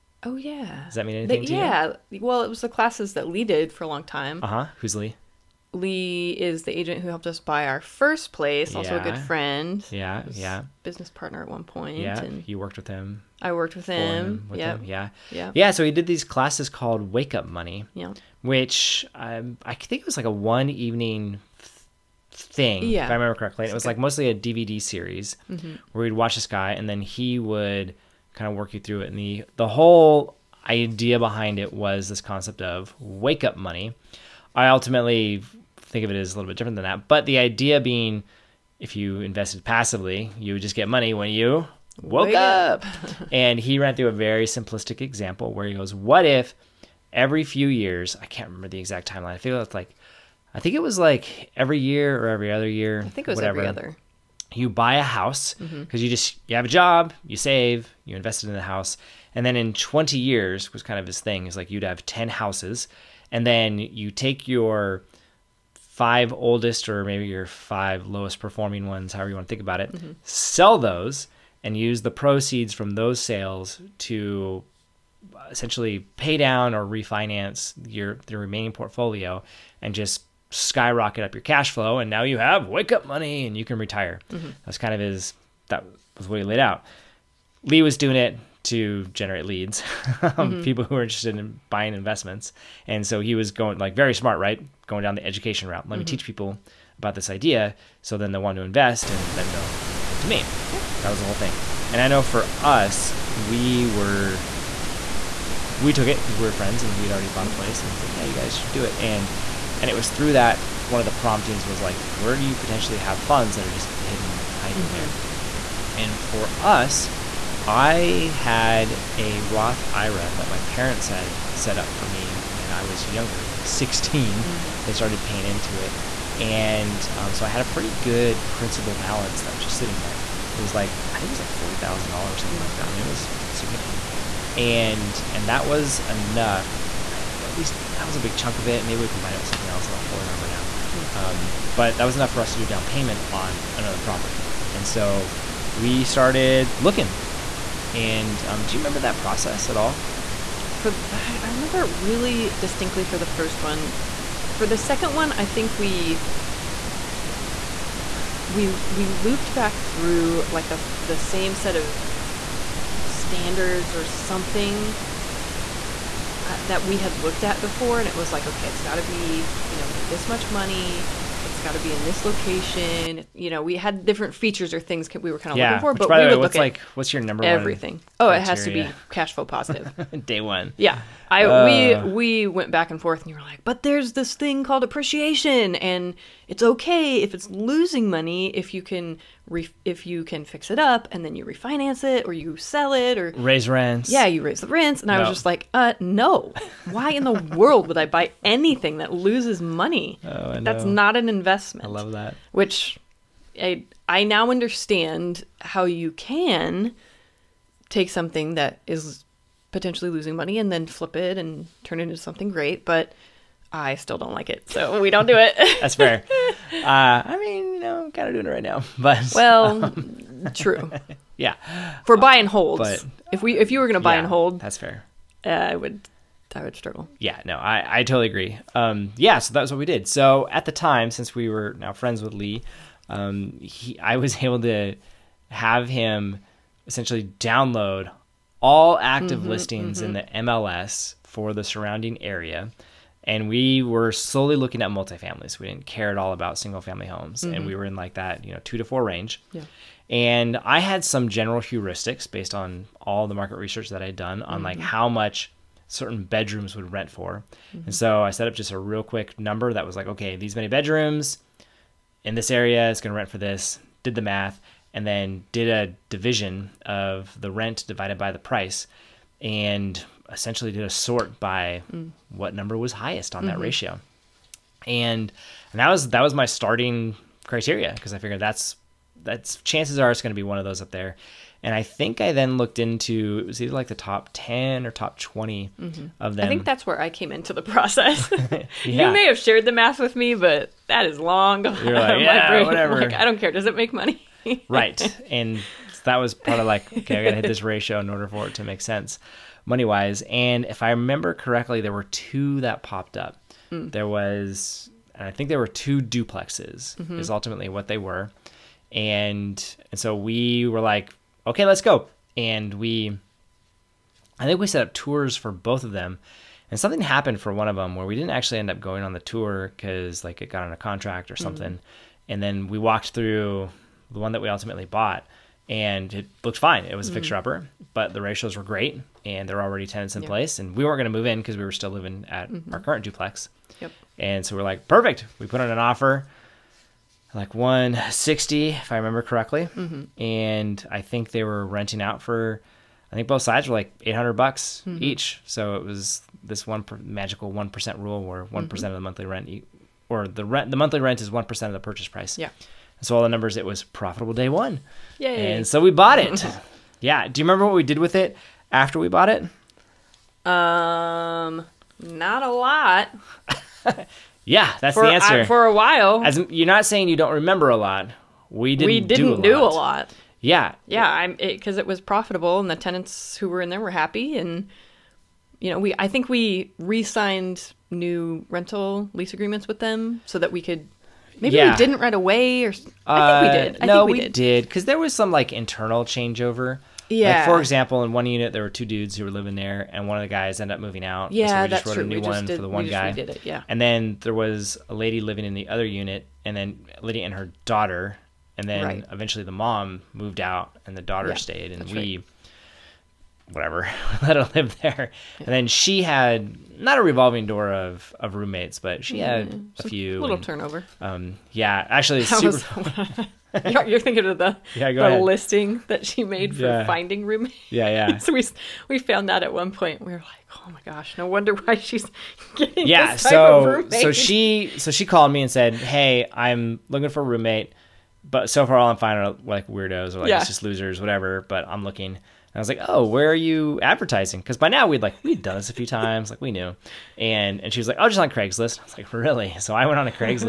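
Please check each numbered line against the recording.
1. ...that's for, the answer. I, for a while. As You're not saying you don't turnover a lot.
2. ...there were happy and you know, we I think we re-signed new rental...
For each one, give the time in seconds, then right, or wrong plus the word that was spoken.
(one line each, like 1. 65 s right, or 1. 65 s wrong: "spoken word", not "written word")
1. 364 s wrong: "remember", not "turnover"
2. 373 s right.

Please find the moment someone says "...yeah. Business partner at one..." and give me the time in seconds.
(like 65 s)
10 s.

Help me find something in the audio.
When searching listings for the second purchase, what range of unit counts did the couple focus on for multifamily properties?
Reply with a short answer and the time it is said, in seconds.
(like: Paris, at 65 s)
two to four, at 248 s.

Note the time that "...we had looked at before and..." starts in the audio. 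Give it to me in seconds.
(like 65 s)
166 s.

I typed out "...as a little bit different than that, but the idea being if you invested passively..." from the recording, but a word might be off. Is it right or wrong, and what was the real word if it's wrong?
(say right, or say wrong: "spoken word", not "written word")
right.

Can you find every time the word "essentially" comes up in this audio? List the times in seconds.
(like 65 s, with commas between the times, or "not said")
75 s, 236 s, 270 s.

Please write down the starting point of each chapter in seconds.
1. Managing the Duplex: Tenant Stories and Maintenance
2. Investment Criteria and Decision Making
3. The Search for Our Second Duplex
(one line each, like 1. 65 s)
1. 352 s
2. 173 s
3. 141 s.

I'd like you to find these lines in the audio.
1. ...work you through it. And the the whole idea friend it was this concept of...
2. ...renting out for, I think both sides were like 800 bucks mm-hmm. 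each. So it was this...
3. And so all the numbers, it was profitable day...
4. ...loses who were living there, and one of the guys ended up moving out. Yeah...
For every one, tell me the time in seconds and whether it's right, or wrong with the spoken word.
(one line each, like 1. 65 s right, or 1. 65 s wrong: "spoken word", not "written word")
1. 28 s wrong: "behind", not "friend"
2. 341 s right
3. 352 s right
4. 388 s wrong: "dudes", not "loses".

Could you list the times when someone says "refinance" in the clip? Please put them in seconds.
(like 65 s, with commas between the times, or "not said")
76 s, 191 s.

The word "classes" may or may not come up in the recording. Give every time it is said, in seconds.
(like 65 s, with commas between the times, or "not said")
2 s, 16 s.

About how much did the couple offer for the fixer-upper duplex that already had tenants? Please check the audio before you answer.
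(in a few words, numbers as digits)
160.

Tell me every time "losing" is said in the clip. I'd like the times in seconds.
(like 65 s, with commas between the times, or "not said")
187 s, 210 s.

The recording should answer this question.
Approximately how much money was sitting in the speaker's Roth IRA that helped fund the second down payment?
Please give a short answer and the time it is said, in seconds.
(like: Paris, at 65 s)
$40,000, at 131 s.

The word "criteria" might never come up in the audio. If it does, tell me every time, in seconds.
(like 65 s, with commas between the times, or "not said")
178 s, 277 s.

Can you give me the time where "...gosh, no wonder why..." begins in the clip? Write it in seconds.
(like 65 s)
420 s.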